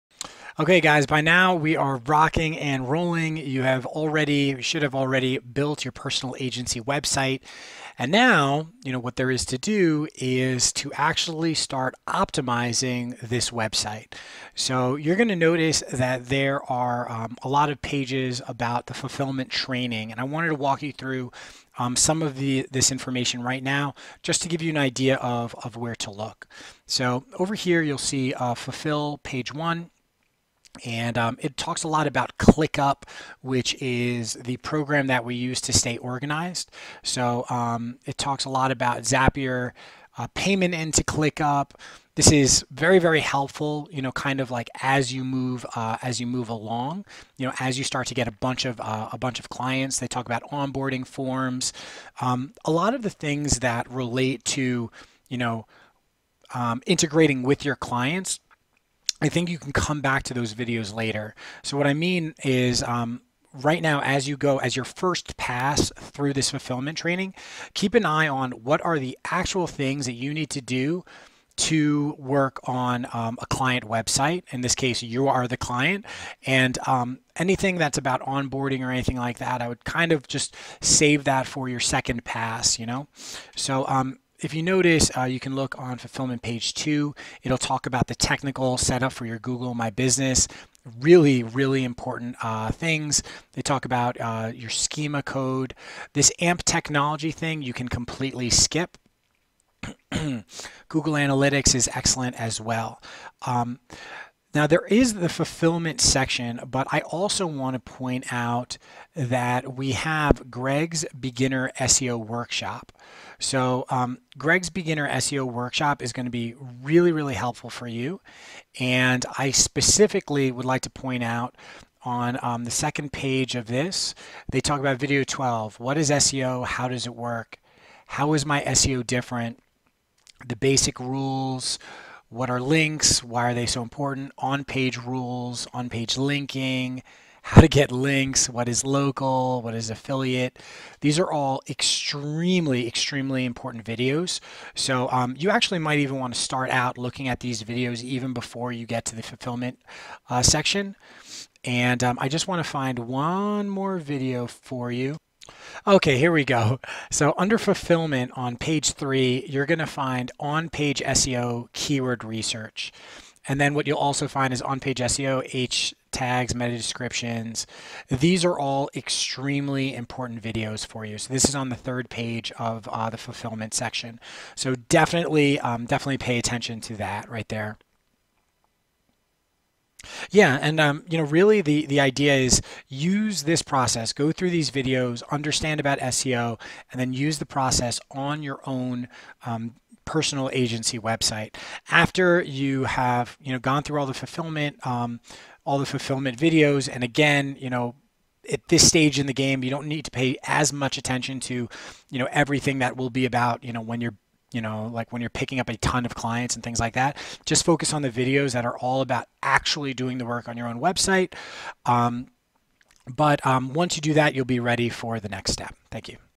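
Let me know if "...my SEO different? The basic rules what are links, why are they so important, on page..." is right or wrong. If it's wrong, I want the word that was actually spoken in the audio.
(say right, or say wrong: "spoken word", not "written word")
right.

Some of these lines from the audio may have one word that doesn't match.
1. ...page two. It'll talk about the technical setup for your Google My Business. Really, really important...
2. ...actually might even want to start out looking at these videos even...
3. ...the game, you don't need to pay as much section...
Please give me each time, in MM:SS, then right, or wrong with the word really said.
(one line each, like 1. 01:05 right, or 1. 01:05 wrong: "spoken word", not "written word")
1. 01:26 right
2. 02:25 right
3. 03:19 wrong: "attention", not "section".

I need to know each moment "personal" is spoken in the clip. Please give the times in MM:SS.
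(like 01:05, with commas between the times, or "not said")
00:05, 03:10.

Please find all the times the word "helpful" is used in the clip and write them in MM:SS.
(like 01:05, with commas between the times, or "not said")
00:43, 01:57.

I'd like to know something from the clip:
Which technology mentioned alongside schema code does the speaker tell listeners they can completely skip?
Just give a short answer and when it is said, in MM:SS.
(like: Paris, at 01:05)
AMP, at 01:36.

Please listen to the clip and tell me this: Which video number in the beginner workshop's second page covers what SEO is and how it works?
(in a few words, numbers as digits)
12.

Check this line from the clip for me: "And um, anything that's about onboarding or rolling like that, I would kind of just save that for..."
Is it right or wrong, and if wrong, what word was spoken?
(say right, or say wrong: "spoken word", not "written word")
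wrong: "anything", not "rolling".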